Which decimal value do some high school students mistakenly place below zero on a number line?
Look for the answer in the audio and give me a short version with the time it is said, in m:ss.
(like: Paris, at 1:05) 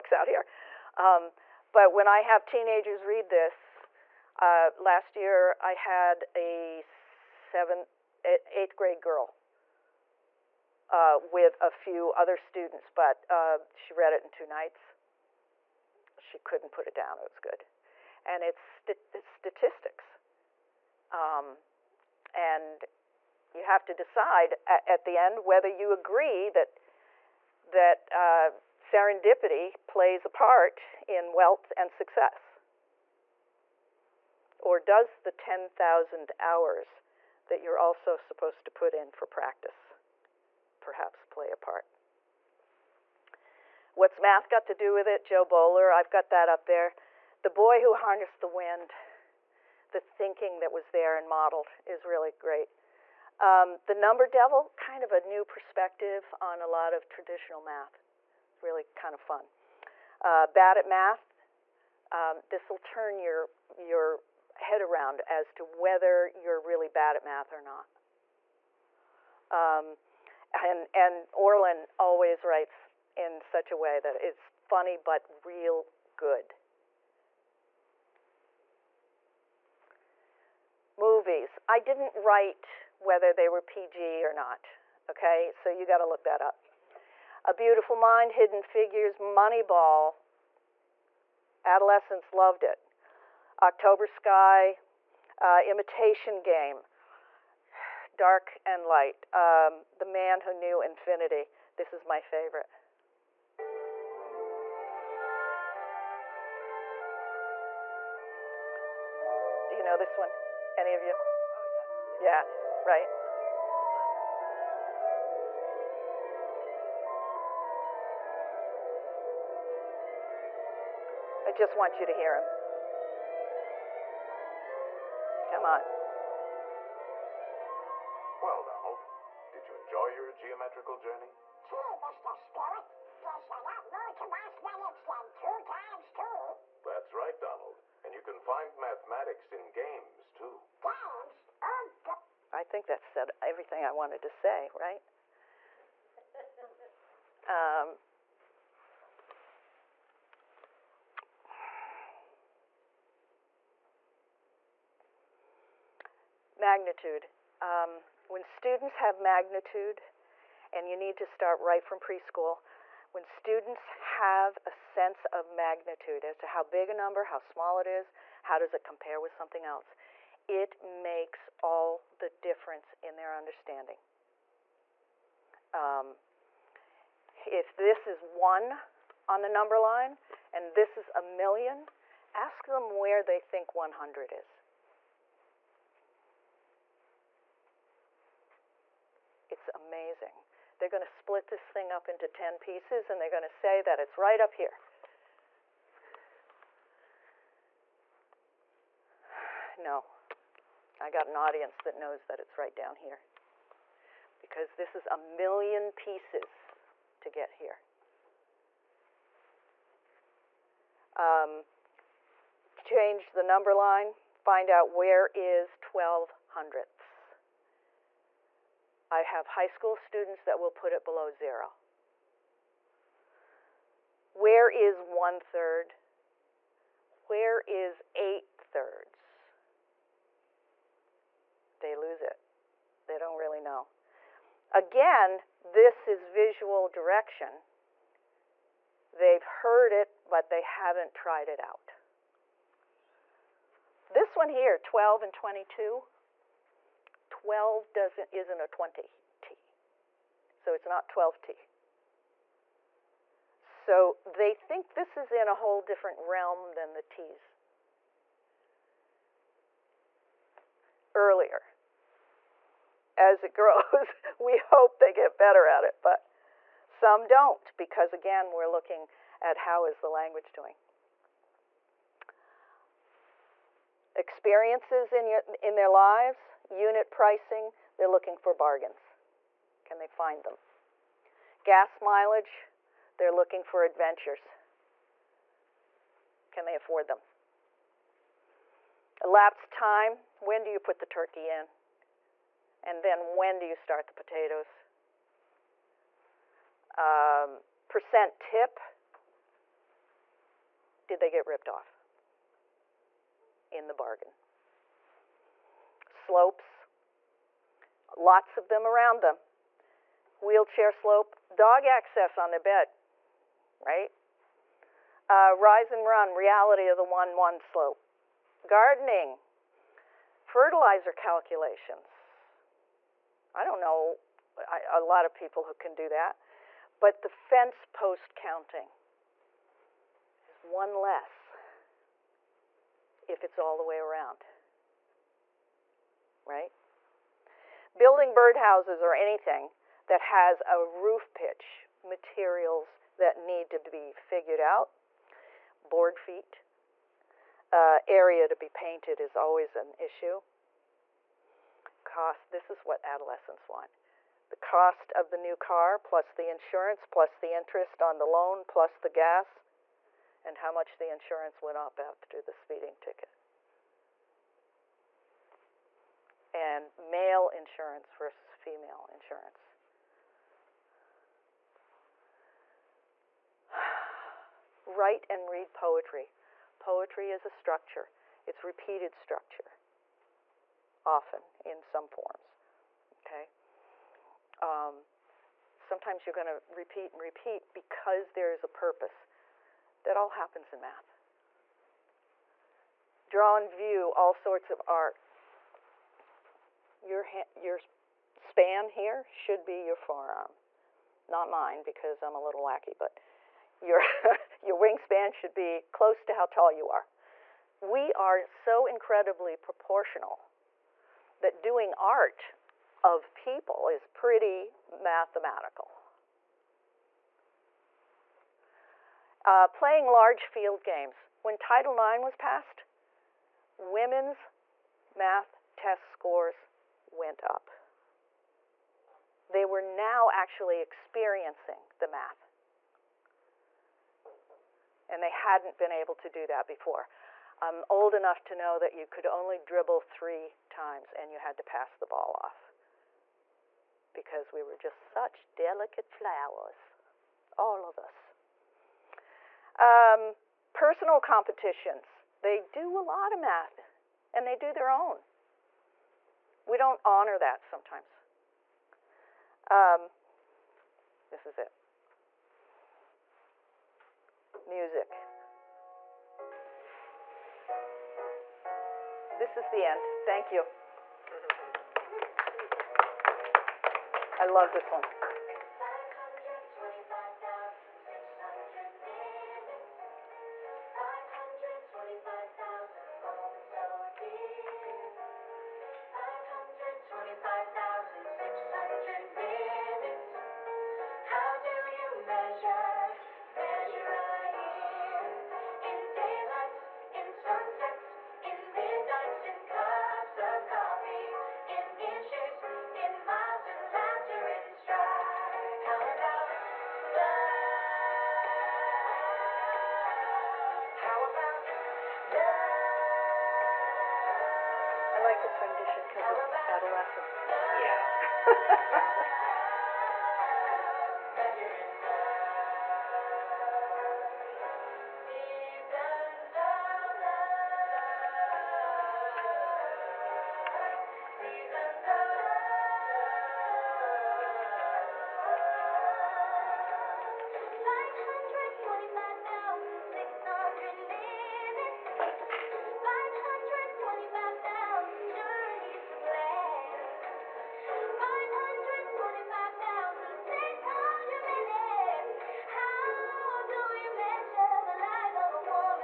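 12 hundredths, at 3:35.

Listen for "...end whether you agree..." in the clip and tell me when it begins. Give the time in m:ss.
0:25.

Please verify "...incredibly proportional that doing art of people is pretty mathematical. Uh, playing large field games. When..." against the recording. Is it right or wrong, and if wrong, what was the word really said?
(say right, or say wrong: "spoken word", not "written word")
right.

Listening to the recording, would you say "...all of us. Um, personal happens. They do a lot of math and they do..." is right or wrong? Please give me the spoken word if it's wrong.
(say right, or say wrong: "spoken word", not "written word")
wrong: "competitions", not "happens".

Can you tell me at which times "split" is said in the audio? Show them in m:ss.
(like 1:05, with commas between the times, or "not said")
3:11.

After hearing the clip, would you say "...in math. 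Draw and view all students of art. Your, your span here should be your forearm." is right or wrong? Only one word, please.
wrong.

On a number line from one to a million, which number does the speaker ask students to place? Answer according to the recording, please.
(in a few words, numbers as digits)
100.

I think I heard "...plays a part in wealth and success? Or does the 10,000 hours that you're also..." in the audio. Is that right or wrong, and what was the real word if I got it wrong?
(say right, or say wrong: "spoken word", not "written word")
right.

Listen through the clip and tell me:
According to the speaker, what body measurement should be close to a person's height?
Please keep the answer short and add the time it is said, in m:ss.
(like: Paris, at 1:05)
wingspan, at 6:44.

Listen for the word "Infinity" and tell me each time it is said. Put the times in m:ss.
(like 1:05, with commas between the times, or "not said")
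1:40.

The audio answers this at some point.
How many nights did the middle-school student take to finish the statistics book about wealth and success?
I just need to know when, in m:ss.
0:14.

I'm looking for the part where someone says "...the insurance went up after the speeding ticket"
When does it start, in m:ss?
6:00.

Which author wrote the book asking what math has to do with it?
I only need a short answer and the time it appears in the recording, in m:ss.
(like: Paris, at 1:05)
Jo Boaler, at 0:45.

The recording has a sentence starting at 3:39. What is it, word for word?
I have high school students that will put it below zero.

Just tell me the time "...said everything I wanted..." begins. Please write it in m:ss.
2:23.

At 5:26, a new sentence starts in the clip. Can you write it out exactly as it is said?
But the fence post counting is one less if it's all the way around, right?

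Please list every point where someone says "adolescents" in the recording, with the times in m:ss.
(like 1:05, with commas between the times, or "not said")
1:31, 5:53.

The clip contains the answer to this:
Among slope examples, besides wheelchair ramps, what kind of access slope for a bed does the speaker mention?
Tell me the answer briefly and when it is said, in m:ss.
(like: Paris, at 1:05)
dog access, at 5:11.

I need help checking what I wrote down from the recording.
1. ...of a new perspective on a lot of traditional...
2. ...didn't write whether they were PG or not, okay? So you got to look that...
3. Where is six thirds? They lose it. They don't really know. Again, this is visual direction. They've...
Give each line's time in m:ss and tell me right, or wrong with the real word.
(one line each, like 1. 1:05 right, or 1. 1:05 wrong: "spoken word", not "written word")
1. 0:55 right
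2. 1:21 right
3. 3:47 wrong: "eight", not "six".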